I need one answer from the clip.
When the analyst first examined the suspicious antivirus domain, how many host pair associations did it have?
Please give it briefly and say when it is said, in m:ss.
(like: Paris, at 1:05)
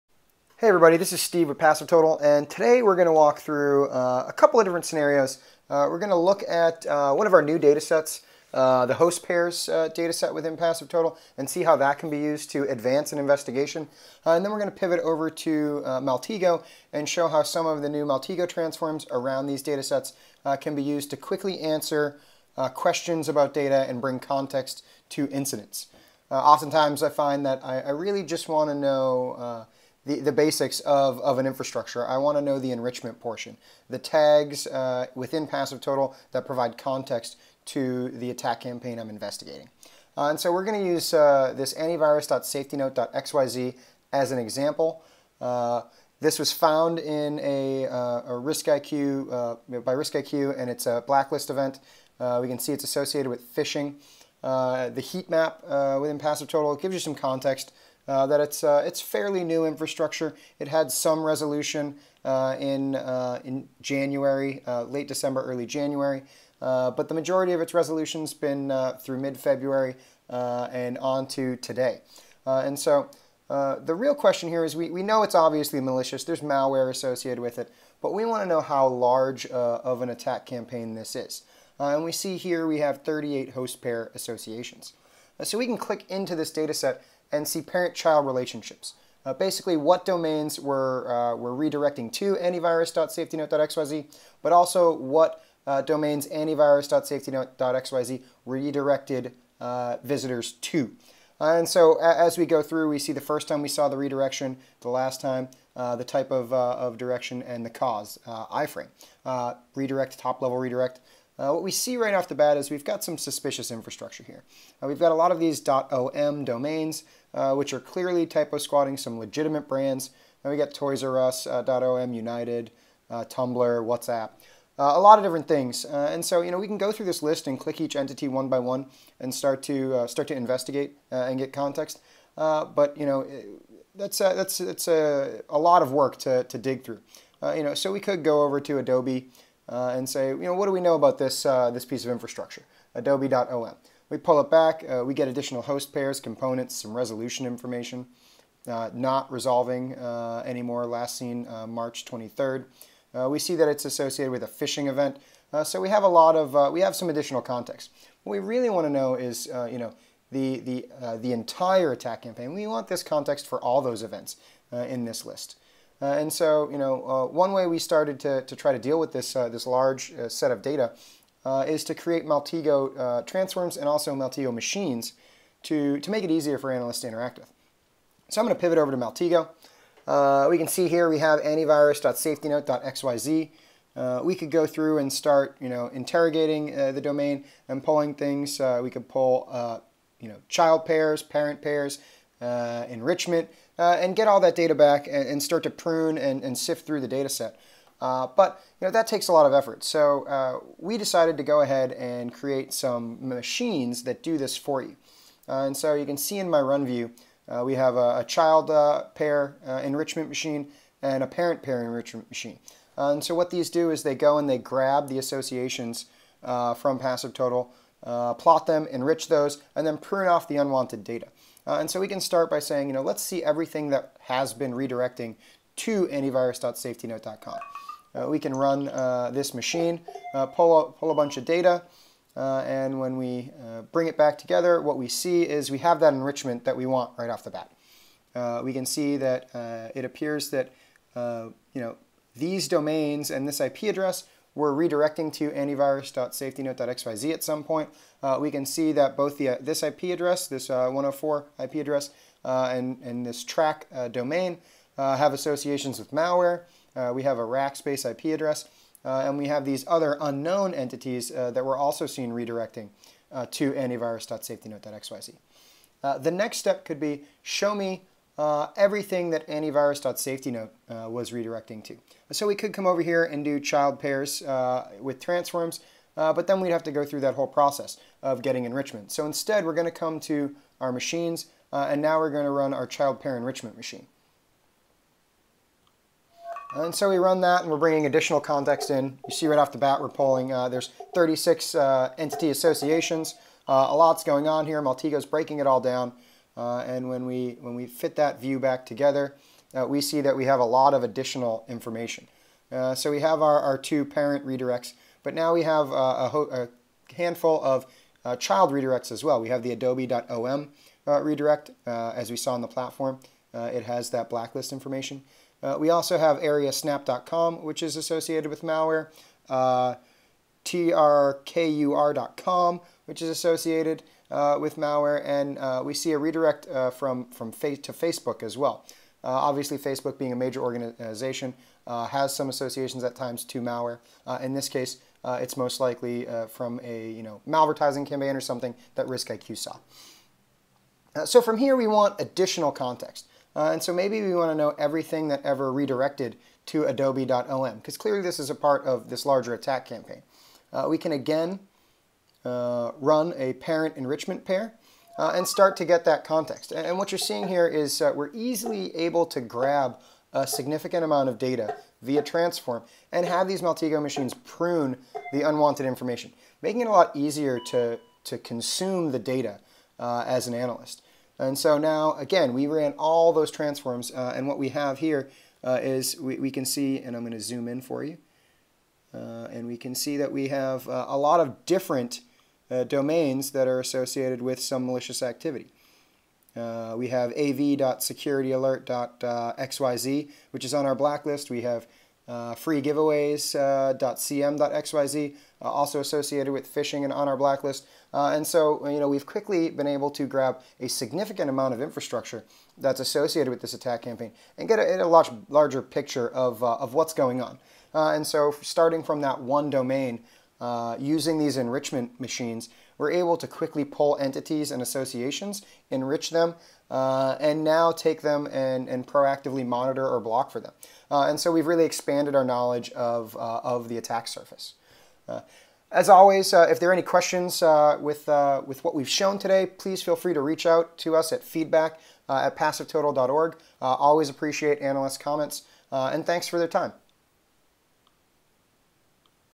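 38, at 1:23.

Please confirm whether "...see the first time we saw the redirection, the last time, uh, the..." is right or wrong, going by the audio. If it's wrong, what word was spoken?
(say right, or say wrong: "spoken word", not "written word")
right.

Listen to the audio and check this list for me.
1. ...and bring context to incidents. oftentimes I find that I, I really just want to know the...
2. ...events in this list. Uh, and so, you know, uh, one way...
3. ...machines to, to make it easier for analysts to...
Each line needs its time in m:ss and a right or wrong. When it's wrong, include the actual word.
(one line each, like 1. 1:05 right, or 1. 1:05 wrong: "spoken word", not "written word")
1. 0:23 right
2. 2:44 right
3. 2:54 right.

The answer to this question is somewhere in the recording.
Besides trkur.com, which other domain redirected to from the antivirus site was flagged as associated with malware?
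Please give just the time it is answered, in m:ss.
5:16.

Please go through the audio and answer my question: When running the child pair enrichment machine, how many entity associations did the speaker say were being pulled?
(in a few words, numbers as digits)
36.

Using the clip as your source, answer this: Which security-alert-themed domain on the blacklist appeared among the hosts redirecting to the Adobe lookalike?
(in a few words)
av.securityalert.xyz.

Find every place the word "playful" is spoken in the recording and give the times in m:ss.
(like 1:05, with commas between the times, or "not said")
not said.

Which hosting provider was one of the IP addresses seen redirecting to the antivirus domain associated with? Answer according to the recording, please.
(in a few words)
Rackspace.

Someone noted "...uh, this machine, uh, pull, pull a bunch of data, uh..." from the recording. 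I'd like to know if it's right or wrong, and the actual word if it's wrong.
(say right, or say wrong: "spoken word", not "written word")
right.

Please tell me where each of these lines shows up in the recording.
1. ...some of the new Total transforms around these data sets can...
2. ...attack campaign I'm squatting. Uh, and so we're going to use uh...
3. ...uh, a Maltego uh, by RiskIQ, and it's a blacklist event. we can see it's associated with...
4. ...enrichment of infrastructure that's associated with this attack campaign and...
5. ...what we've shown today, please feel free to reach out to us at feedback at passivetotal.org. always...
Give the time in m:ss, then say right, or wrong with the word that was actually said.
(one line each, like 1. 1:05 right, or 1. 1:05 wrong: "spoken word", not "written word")
1. 0:17 wrong: "Maltego", not "Total"
2. 0:38 wrong: "investigating", not "squatting"
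3. 0:47 wrong: "RiskIQ", not "Maltego"
4. 6:41 wrong: "amount", not "enrichment"
5. 7:08 right.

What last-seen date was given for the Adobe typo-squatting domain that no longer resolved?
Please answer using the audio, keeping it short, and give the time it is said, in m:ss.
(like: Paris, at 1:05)
March 23rd, at 2:31.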